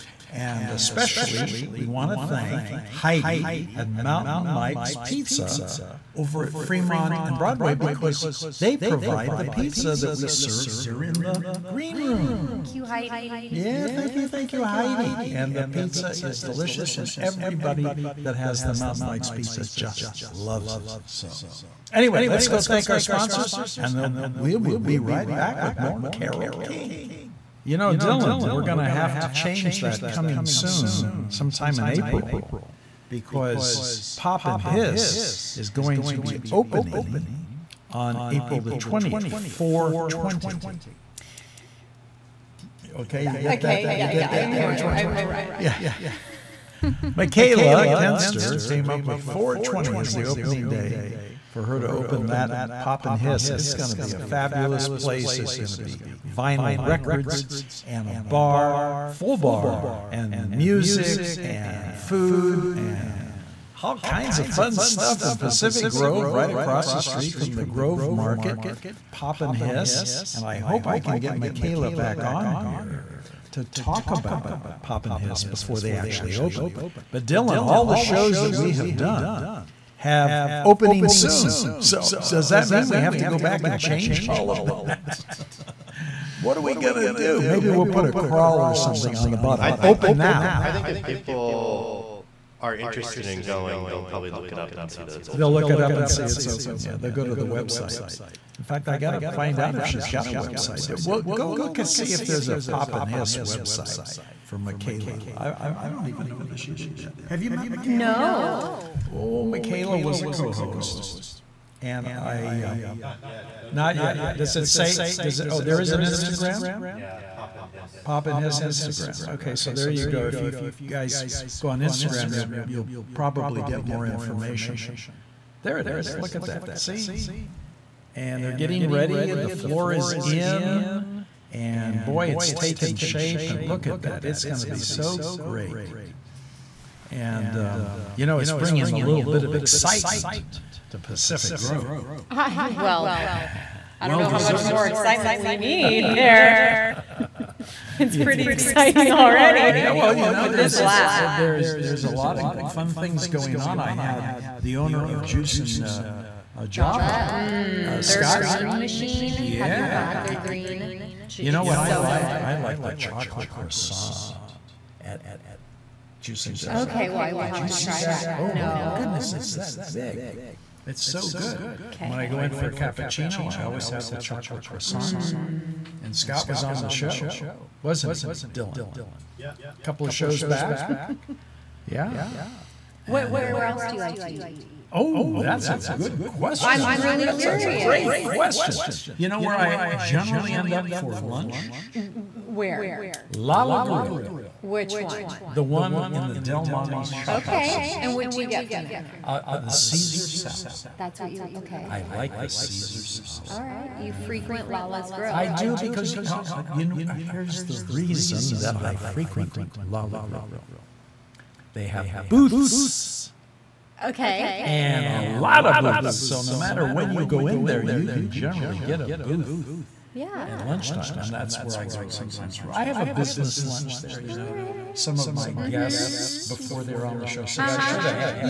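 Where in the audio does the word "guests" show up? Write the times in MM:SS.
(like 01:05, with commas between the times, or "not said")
03:45.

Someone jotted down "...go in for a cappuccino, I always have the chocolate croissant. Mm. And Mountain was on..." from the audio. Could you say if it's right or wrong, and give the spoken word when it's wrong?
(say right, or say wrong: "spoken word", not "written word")
wrong: "Scott", not "Mountain".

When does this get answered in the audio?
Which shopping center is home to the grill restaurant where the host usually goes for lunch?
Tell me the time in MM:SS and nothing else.
03:16.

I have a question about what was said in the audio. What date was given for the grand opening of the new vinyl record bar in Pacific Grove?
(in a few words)
April 20th.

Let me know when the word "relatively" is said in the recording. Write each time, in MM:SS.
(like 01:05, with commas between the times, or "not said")
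not said.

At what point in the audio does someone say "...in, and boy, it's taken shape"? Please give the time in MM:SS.
02:10.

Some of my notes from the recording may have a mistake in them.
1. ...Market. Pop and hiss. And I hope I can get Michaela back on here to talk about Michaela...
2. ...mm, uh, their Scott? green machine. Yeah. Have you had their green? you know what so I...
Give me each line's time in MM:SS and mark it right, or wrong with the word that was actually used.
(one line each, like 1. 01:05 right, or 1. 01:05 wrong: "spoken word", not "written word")
1. 01:08 wrong: "Pop", not "Michaela"
2. 02:37 right.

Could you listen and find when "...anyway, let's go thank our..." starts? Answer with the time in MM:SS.
00:21.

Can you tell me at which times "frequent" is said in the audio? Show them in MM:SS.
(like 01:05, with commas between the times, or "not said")
03:24, 03:28.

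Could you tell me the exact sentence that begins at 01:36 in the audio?
Yeah, they'll go to the website.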